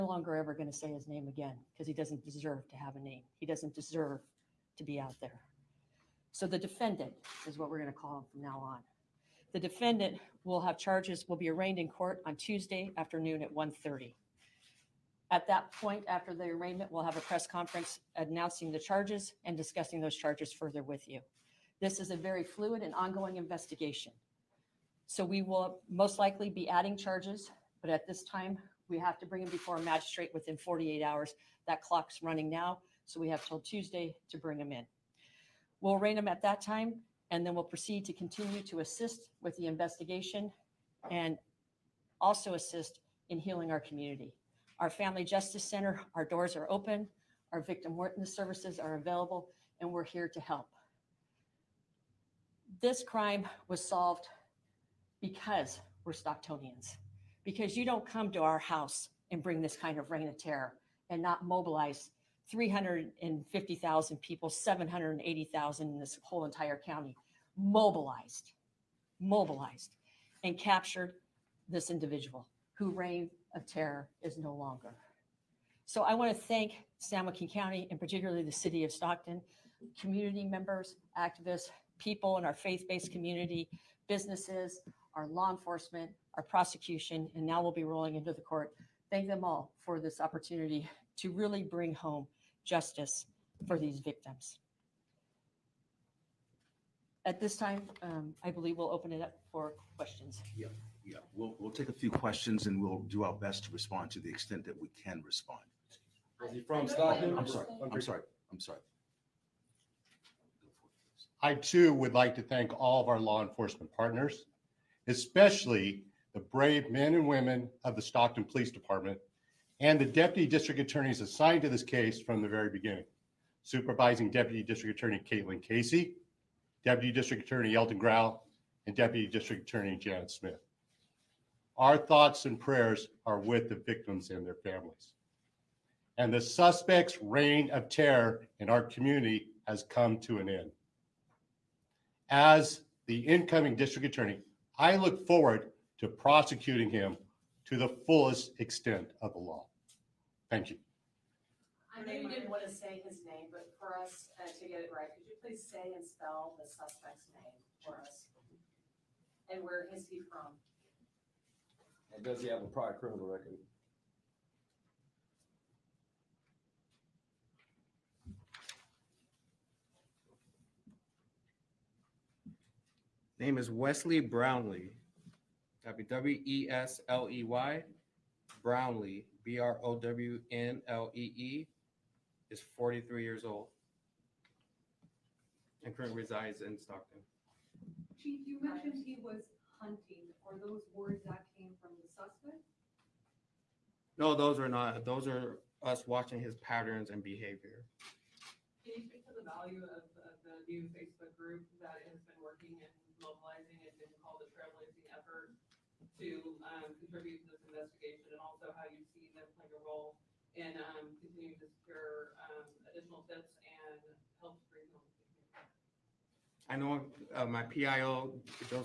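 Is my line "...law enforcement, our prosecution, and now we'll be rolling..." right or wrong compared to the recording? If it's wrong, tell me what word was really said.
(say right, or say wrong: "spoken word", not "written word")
right.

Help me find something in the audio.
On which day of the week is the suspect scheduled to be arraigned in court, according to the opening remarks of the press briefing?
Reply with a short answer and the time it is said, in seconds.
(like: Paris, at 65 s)
Tuesday afternoon, at 12 s.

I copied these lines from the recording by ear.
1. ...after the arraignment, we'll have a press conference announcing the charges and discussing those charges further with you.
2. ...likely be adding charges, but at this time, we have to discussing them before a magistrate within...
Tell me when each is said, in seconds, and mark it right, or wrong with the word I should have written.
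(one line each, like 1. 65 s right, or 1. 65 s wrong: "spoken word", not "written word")
1. 16 s right
2. 26 s wrong: "bring", not "discussing".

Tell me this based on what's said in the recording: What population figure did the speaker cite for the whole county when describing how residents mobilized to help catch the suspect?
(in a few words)
780,000.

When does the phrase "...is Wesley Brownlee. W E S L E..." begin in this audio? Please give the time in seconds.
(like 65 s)
173 s.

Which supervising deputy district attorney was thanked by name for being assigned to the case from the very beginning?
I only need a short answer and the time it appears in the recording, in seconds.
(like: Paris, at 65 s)
Caitlin Casey, at 125 s.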